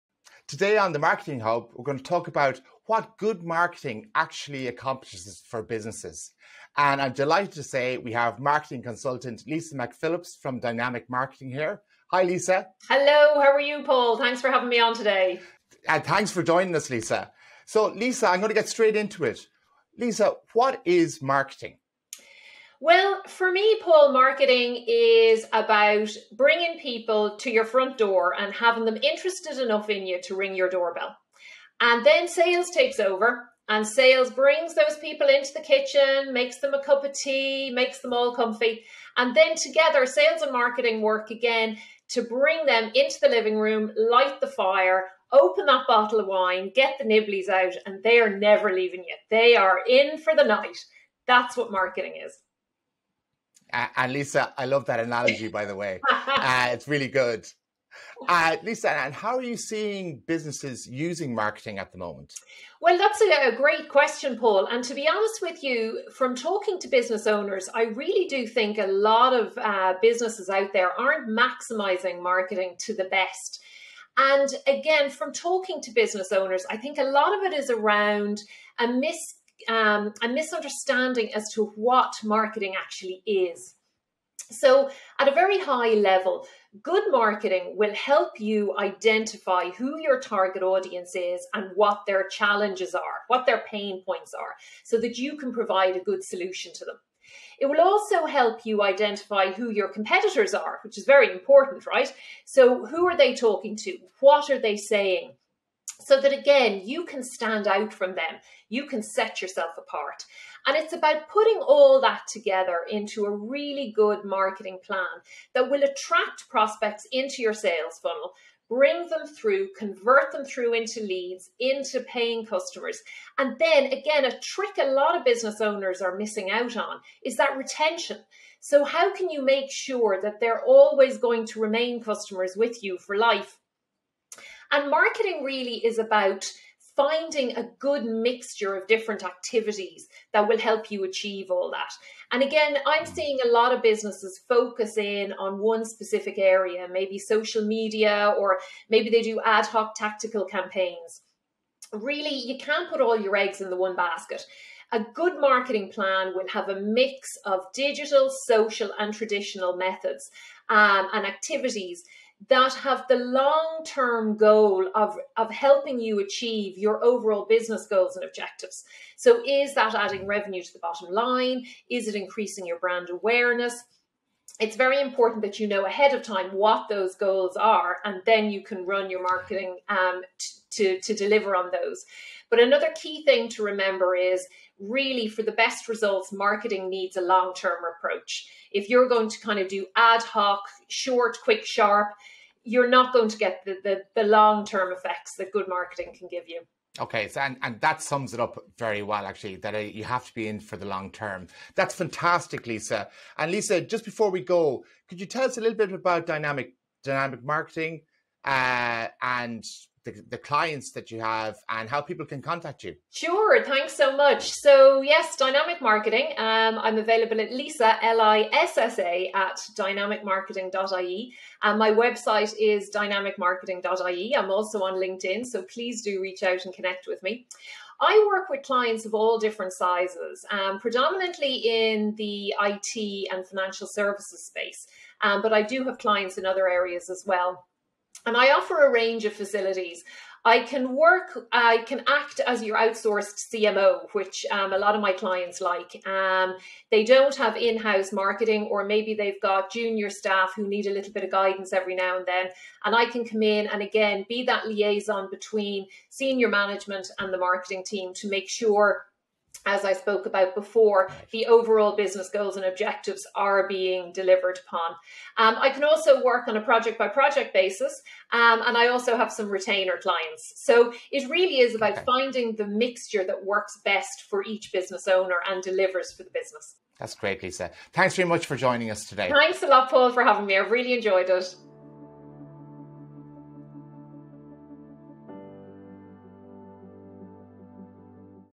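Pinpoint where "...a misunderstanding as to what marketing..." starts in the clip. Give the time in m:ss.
1:20.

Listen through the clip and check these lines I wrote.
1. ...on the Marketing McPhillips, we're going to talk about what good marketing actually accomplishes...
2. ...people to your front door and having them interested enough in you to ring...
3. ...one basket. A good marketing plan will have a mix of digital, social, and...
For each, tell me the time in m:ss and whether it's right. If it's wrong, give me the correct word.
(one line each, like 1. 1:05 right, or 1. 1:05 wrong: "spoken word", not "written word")
1. 0:00 wrong: "Hub", not "McPhillips"
2. 0:26 right
3. 2:33 right.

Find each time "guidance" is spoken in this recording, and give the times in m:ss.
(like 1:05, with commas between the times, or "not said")
4:11.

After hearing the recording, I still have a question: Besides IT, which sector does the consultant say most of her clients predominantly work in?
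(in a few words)
financial services.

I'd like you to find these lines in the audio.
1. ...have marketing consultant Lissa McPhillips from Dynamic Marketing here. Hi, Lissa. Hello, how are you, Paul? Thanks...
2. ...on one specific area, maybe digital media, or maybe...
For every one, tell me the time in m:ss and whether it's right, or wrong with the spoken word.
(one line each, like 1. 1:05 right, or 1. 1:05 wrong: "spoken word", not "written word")
1. 0:08 right
2. 2:25 wrong: "social", not "digital".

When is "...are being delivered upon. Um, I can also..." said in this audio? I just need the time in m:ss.
4:23.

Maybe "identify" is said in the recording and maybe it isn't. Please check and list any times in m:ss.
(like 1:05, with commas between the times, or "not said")
1:28, 1:38.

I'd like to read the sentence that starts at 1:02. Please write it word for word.
Well, that's a, a, great question, Paul.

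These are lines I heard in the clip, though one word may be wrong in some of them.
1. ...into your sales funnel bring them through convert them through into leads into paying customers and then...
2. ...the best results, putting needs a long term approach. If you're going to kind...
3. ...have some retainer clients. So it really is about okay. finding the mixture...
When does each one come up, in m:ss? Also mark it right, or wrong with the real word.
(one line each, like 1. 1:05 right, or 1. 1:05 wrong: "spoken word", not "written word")
1. 1:57 right
2. 3:05 wrong: "marketing", not "putting"
3. 4:29 right.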